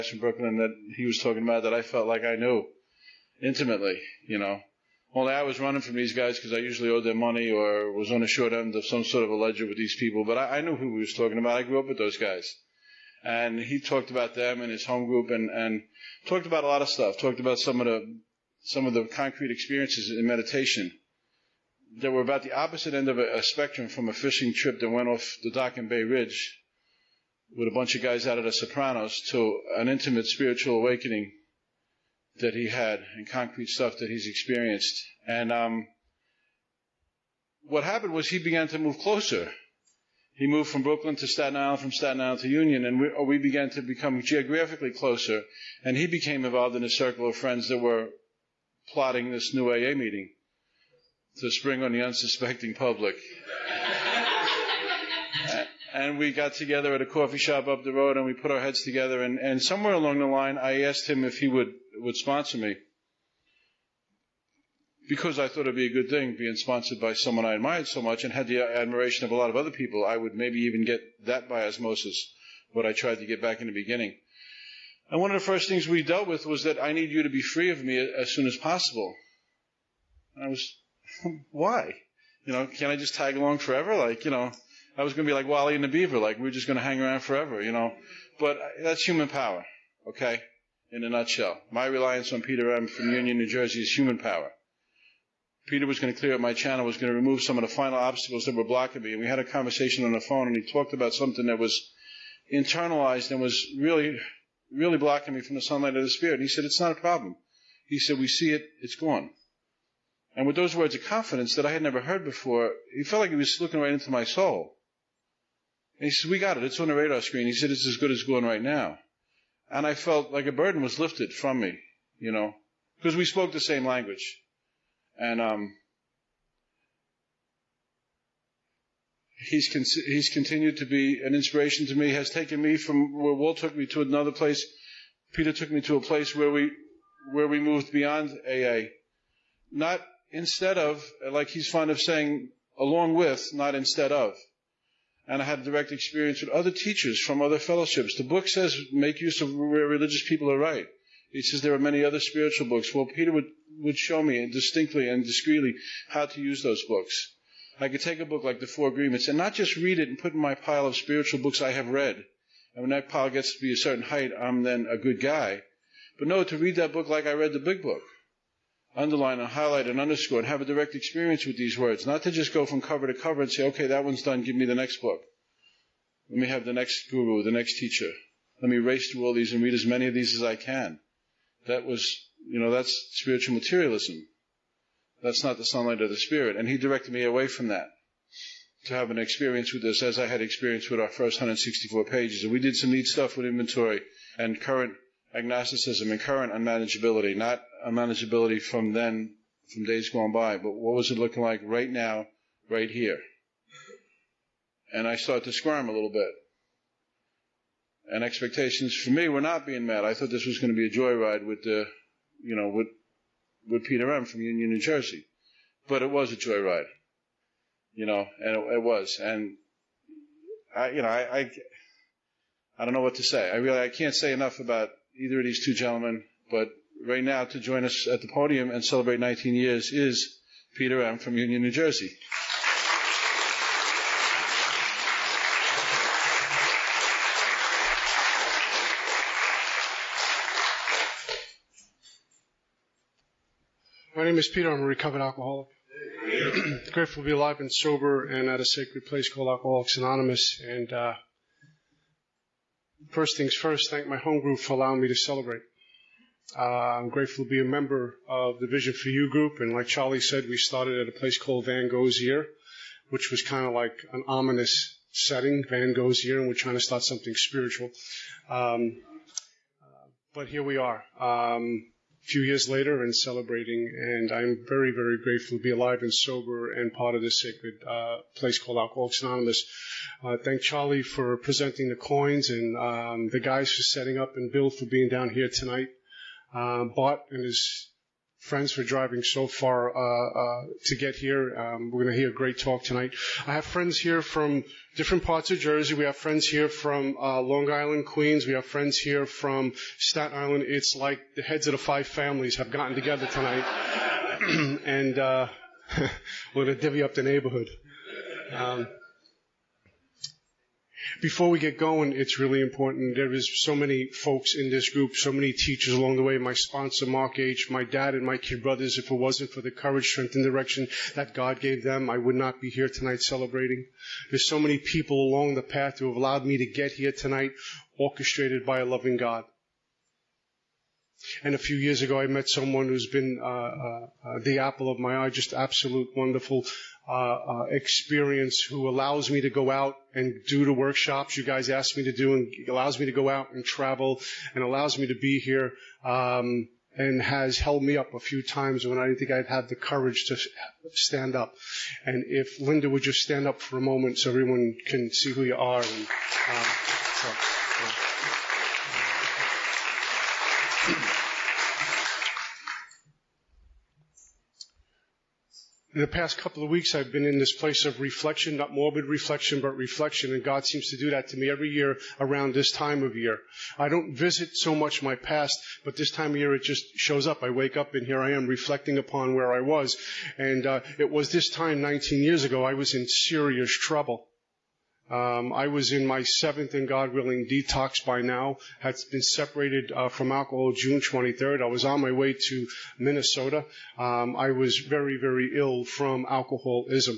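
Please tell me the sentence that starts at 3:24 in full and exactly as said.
And I started to squirm a little bit.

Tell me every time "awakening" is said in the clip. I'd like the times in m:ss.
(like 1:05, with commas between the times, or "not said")
0:30.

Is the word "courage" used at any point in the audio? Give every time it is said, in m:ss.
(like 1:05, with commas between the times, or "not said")
5:19, 5:49.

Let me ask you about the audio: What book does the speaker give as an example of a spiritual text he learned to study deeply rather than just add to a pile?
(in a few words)
The Four Agreements.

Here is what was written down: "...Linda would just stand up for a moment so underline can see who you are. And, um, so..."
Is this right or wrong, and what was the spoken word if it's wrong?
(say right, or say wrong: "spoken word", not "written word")
wrong: "everyone", not "underline".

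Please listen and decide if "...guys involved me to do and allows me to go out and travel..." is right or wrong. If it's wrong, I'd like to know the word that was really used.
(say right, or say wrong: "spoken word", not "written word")
wrong: "asked", not "involved".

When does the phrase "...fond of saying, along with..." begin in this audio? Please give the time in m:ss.
2:21.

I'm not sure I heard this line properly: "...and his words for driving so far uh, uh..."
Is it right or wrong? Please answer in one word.
wrong.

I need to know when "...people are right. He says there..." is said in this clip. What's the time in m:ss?
2:30.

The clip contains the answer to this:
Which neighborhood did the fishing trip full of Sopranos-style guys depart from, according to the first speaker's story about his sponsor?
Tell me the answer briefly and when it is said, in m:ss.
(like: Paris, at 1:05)
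Bay Ridge, at 0:25.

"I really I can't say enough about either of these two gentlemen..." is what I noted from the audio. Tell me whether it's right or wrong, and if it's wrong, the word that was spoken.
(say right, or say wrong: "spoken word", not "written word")
right.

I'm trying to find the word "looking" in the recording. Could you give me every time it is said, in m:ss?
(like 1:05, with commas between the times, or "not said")
1:53, 3:21.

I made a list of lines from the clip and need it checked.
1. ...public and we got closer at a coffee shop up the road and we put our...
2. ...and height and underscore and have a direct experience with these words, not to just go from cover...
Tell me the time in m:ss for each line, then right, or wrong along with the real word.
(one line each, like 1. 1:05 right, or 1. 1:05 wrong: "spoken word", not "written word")
1. 0:52 wrong: "together", not "closer"
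2. 2:49 wrong: "highlight", not "height".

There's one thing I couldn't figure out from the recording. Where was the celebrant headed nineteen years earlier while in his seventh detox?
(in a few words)
Minnesota.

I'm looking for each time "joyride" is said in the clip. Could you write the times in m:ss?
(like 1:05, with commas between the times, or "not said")
3:30, 3:36.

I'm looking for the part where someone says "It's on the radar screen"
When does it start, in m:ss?
1:56.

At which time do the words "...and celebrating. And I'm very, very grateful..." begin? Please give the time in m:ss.
4:33.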